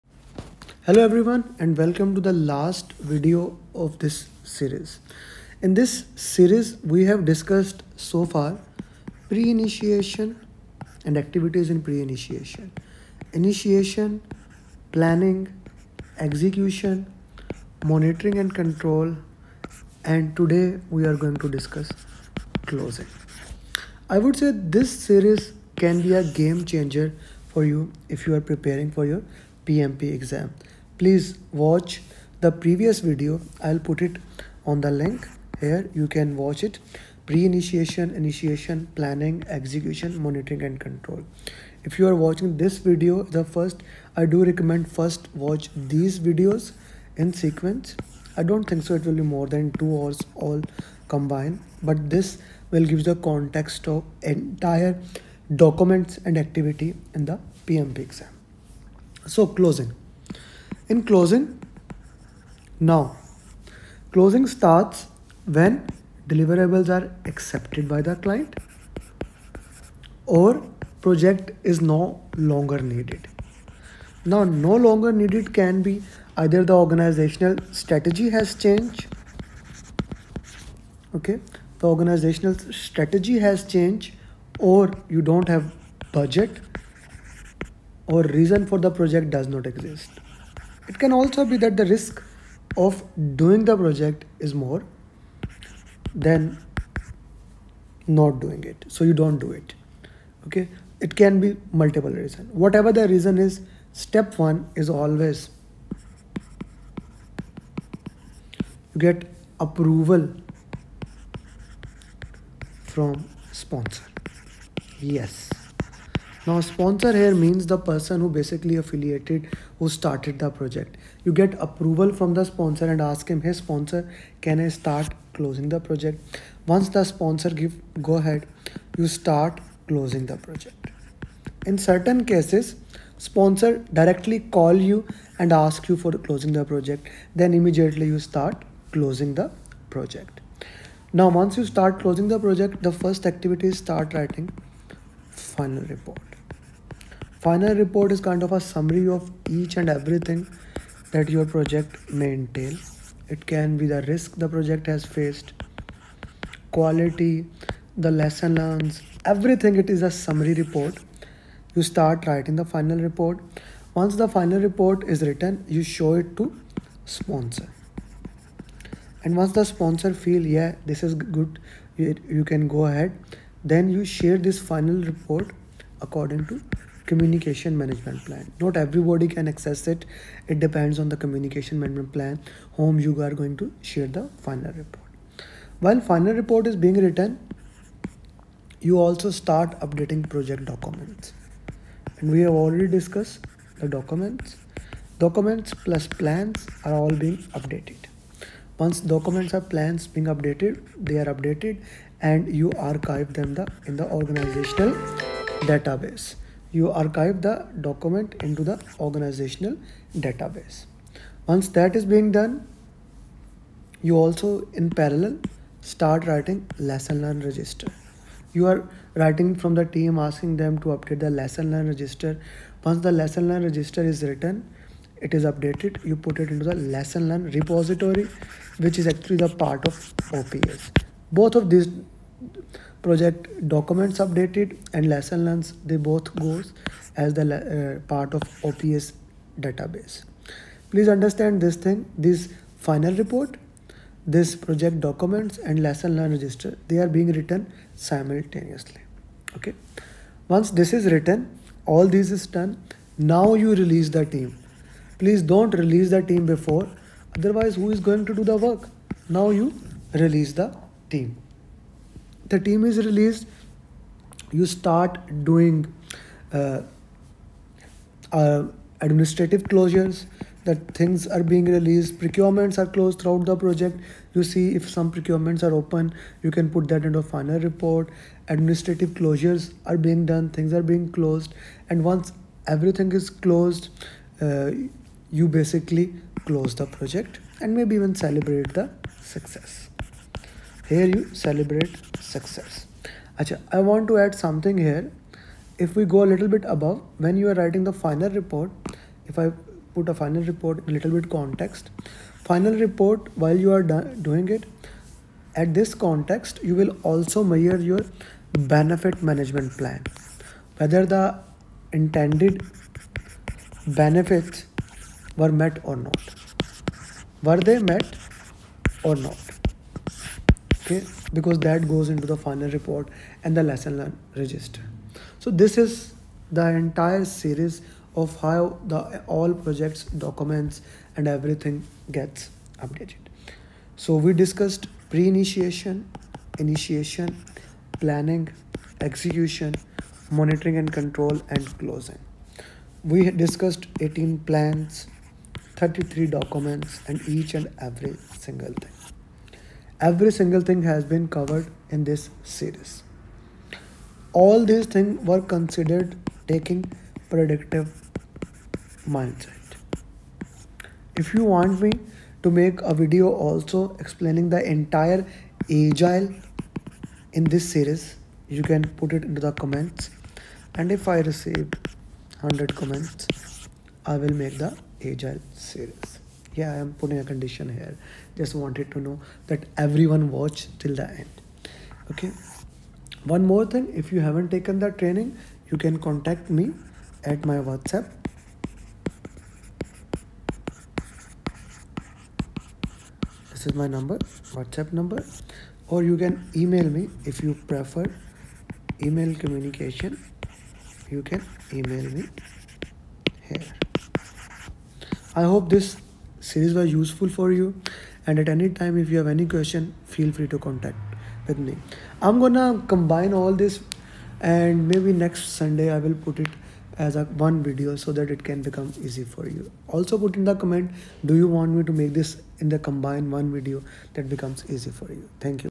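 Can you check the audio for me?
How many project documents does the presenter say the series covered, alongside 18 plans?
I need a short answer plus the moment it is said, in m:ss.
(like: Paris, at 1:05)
33, at 5:45.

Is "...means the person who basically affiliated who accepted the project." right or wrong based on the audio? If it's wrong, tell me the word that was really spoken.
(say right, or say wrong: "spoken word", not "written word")
wrong: "started", not "accepted".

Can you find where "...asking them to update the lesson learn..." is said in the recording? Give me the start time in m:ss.
3:40.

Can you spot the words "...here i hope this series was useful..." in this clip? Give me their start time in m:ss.
6:43.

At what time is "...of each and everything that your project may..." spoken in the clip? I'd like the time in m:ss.
2:29.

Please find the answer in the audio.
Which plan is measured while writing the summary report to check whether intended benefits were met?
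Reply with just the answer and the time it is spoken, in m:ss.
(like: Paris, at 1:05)
benefit management plan, at 5:08.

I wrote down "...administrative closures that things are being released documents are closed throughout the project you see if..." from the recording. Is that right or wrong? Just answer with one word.
wrong.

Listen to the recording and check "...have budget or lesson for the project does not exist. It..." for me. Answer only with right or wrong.
wrong.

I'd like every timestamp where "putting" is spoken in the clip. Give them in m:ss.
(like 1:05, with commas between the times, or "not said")
6:16.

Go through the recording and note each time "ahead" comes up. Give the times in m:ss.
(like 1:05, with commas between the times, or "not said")
2:08, 2:52.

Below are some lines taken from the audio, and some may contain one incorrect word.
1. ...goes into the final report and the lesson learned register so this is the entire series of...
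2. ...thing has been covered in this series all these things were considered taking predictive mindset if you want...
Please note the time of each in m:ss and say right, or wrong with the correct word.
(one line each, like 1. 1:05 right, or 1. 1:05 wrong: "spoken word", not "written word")
1. 5:21 right
2. 5:50 right.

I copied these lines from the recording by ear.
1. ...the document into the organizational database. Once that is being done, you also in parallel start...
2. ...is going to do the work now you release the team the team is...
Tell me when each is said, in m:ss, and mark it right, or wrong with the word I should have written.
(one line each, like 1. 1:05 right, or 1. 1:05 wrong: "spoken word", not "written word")
1. 3:27 right
2. 4:17 right.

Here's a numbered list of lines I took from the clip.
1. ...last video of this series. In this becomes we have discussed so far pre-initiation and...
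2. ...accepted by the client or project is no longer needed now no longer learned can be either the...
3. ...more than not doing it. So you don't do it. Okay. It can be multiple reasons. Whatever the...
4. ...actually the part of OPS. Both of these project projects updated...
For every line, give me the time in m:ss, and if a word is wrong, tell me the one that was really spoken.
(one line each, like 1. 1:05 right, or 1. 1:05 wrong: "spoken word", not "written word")
1. 0:02 wrong: "series", not "becomes"
2. 1:07 wrong: "needed", not "learned"
3. 1:34 right
4. 3:49 wrong: "documents", not "projects".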